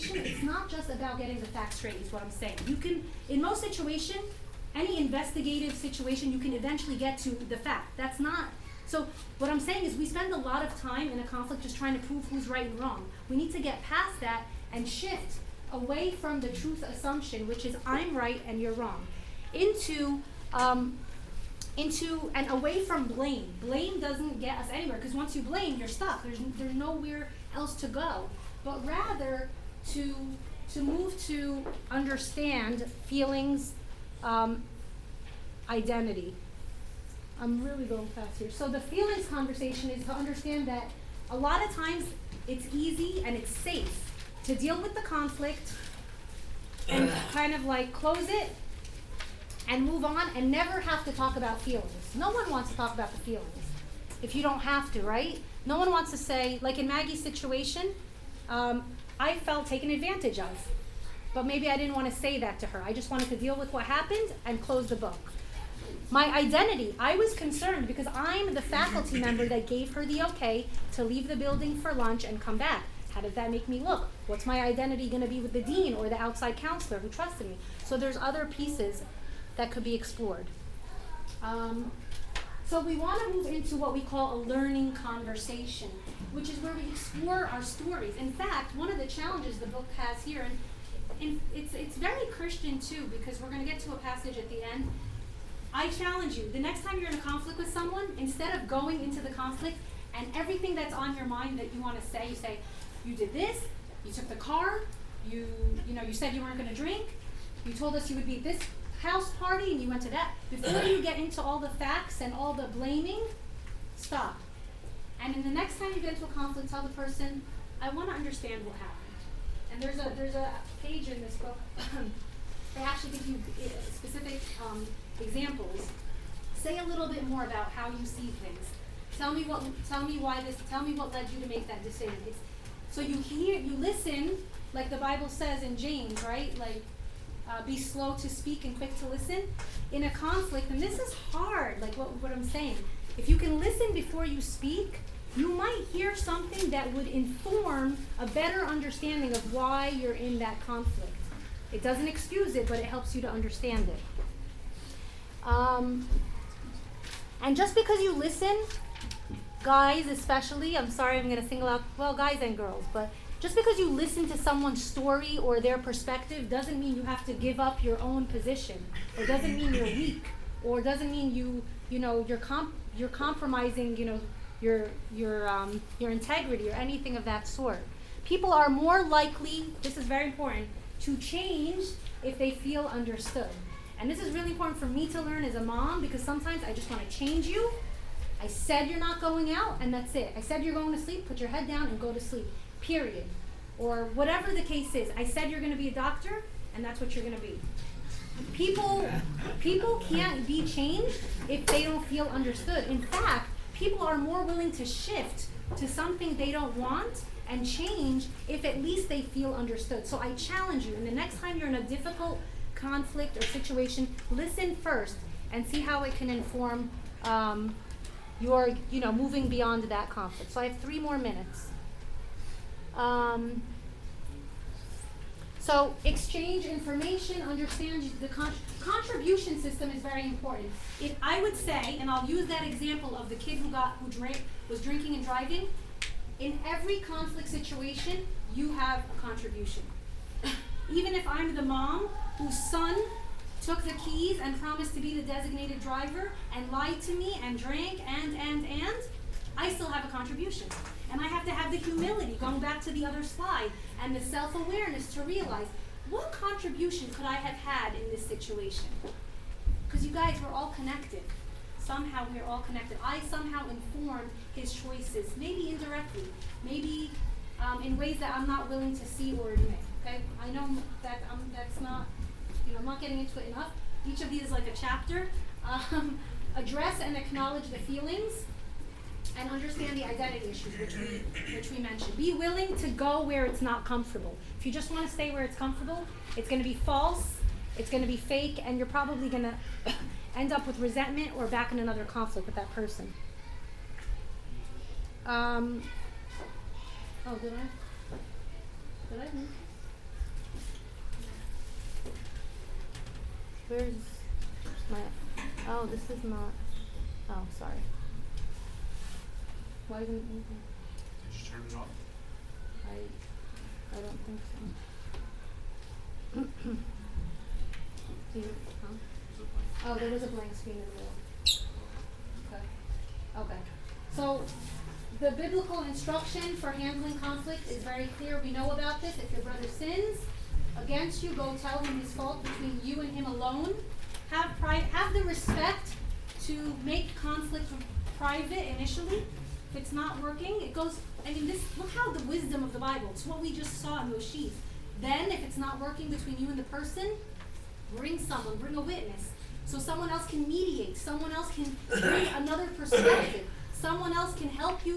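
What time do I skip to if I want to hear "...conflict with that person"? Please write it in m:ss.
4:52.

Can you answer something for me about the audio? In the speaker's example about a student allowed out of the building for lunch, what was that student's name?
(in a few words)
Maggie.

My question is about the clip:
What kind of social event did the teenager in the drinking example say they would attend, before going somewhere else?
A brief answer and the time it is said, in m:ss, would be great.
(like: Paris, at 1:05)
house party, at 1:49.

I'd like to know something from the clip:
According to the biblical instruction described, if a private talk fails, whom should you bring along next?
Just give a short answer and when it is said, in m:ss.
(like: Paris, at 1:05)
a witness, at 5:48.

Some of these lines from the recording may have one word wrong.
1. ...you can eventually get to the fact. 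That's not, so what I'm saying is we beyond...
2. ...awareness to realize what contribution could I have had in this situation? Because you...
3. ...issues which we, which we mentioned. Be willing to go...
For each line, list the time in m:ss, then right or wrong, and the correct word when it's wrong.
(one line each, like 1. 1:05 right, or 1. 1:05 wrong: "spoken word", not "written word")
1. 0:06 wrong: "spend", not "beyond"
2. 4:14 right
3. 4:40 right.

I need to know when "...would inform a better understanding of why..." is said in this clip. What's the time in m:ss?
2:26.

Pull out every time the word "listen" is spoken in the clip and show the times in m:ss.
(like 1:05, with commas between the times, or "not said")
2:13, 2:19, 2:23, 2:38, 2:43, 3:34.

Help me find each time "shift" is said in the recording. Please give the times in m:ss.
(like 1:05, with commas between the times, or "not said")
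0:14, 3:24.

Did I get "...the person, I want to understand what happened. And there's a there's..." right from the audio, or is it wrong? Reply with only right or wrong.
right.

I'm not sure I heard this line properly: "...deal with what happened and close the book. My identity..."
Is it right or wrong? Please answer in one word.
right.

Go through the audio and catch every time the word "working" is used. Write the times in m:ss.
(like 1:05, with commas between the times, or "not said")
5:40, 5:45.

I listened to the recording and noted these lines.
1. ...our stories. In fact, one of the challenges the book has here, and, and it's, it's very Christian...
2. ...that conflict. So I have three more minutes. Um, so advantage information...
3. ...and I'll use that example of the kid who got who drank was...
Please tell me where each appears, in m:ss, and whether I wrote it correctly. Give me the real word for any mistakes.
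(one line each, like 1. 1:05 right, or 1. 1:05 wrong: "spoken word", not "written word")
1. 1:27 right
2. 3:39 wrong: "exchange", not "advantage"
3. 3:51 right.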